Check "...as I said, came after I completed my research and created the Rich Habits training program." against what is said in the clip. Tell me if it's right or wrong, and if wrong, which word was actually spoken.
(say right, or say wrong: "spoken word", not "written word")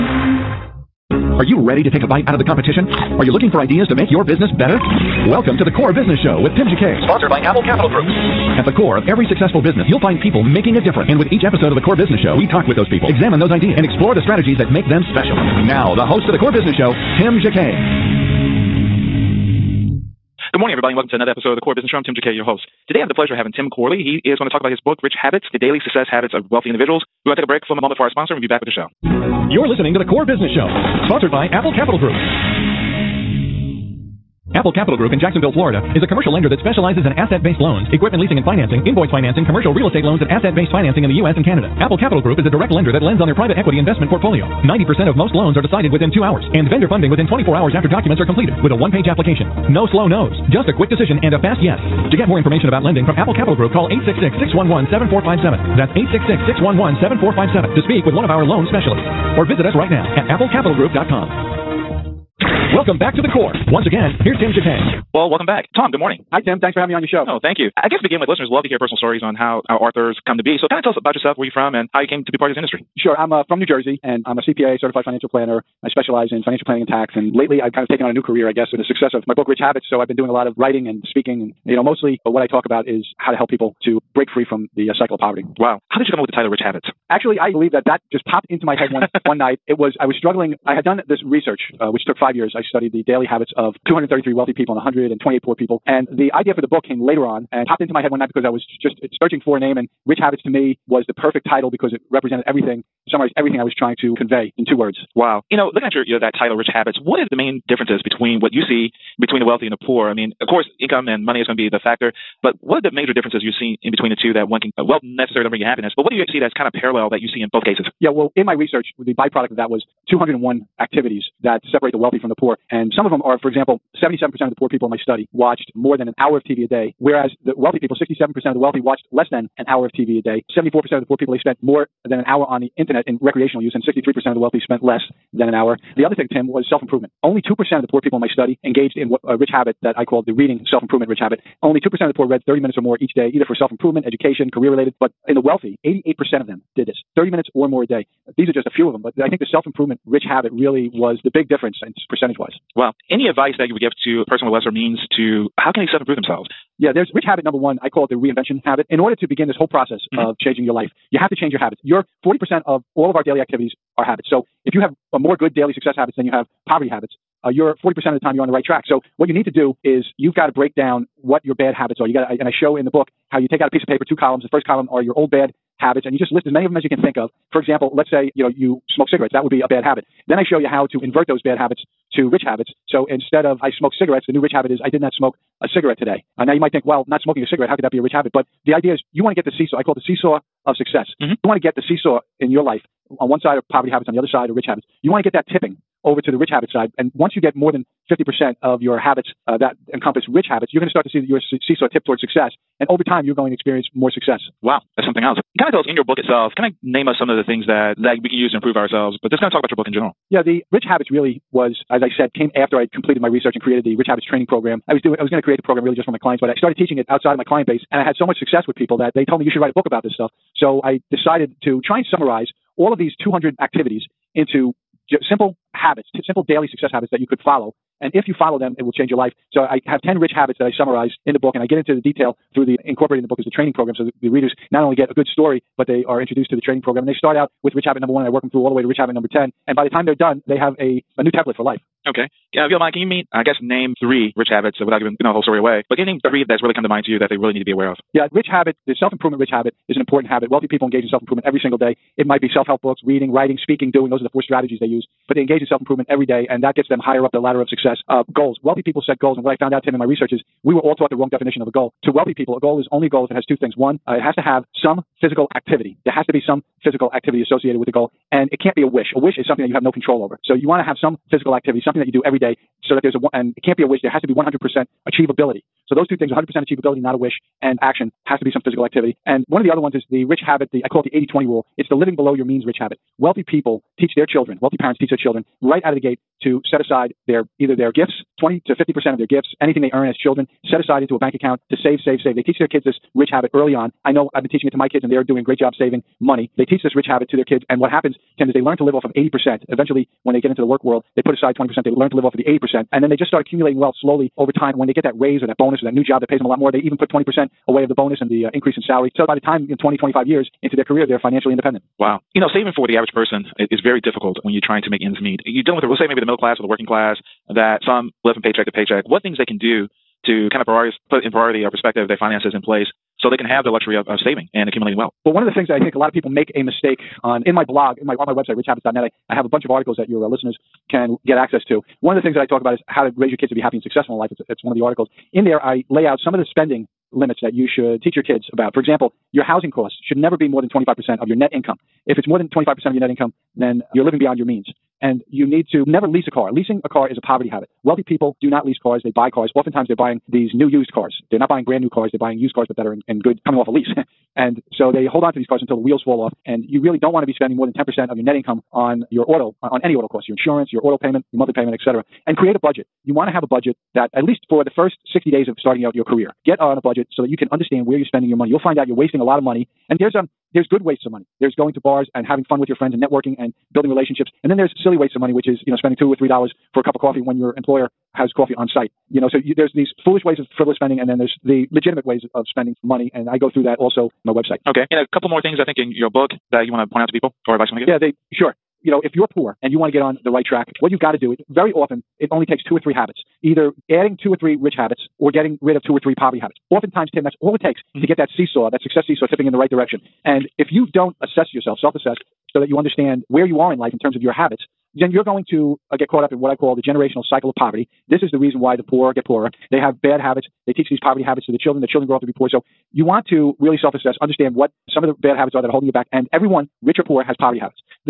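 right.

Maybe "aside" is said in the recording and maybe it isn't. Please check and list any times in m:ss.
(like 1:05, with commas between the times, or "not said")
4:46, 4:50, 5:01.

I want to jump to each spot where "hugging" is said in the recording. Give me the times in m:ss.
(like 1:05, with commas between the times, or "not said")
not said.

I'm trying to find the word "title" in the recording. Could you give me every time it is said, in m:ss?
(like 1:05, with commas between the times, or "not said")
1:26, 1:41, 1:46.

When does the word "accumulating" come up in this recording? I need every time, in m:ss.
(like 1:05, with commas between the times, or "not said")
5:03, 5:24.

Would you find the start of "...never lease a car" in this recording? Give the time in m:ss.
5:45.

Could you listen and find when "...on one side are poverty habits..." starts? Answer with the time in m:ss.
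3:13.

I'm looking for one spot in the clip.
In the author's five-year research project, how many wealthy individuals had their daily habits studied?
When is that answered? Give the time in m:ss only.
1:33.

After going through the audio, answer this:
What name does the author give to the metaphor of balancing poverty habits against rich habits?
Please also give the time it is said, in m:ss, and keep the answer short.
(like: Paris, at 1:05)
seesaw of success, at 3:10.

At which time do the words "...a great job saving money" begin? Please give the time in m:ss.
4:55.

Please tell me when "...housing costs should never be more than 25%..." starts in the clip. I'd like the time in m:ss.
5:39.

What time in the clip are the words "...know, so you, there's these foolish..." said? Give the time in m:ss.
6:19.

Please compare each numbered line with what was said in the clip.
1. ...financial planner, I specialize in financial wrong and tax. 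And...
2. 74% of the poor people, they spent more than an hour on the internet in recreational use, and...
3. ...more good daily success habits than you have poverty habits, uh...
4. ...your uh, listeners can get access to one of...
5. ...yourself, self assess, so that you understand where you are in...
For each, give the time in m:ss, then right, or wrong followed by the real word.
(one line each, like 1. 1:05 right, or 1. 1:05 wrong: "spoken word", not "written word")
1. 1:15 wrong: "planning", not "wrong"
2. 2:10 right
3. 2:45 right
4. 5:30 right
5. 6:41 right.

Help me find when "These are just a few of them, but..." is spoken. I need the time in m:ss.
2:28.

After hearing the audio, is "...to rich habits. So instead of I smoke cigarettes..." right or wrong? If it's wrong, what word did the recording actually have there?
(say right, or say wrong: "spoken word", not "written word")
right.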